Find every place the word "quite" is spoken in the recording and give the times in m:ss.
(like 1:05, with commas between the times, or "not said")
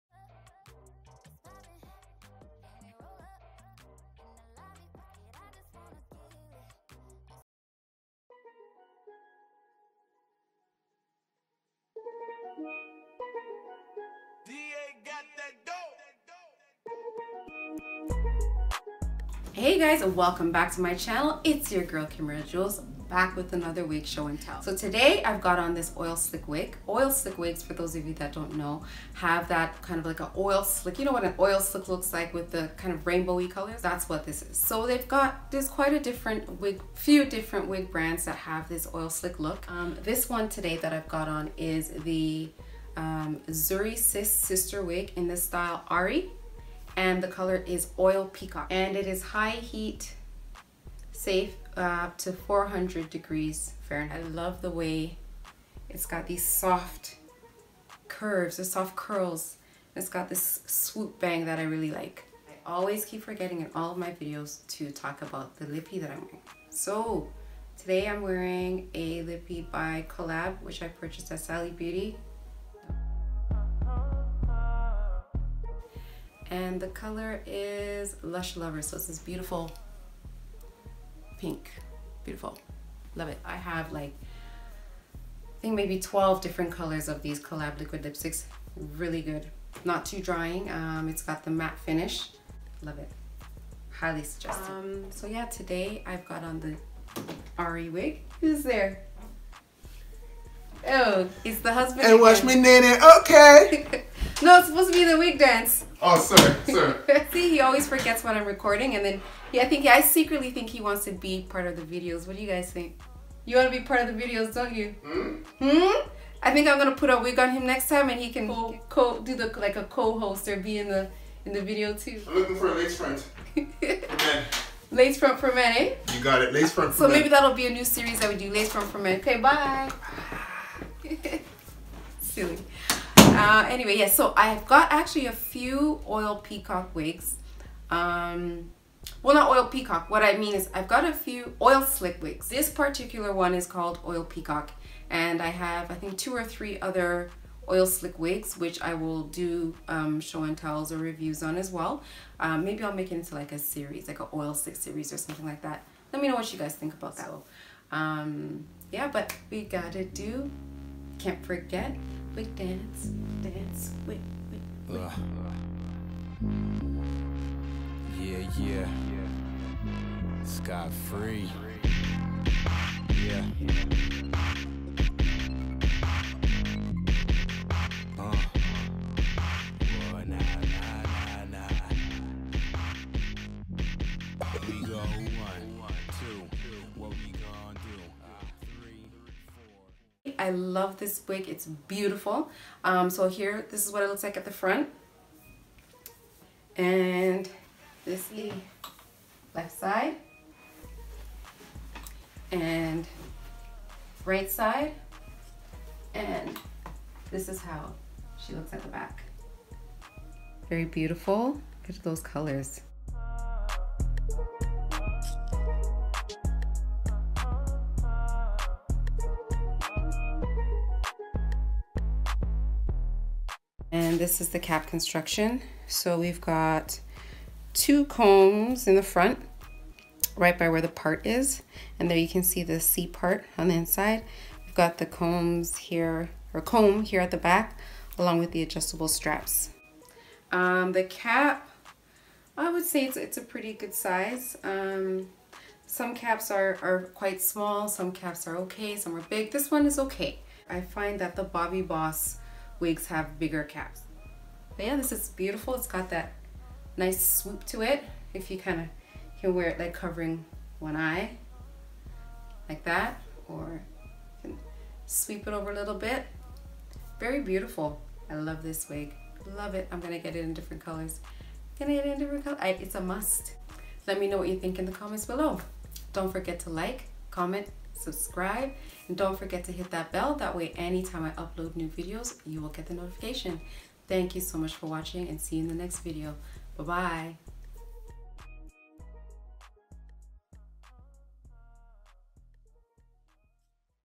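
0:35, 4:07.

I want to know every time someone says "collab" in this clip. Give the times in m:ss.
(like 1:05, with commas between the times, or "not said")
1:10, 1:27.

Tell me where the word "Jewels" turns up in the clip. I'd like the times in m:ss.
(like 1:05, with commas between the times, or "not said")
0:22.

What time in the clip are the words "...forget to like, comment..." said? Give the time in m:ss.
4:36.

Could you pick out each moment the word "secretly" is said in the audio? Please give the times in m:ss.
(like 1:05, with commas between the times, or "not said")
1:50.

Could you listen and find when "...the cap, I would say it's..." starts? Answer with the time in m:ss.
4:00.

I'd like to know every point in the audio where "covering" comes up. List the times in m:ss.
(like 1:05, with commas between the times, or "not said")
4:19.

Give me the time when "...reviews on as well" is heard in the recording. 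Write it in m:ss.
2:30.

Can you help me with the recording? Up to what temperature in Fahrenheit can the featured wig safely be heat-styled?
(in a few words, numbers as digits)
400 degrees.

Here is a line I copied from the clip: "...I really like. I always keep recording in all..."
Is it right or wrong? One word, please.
wrong.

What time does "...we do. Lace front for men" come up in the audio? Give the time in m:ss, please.
2:08.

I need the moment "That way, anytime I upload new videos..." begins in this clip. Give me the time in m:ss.
4:40.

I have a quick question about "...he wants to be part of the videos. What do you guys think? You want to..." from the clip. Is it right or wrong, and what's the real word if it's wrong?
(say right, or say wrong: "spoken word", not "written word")
right.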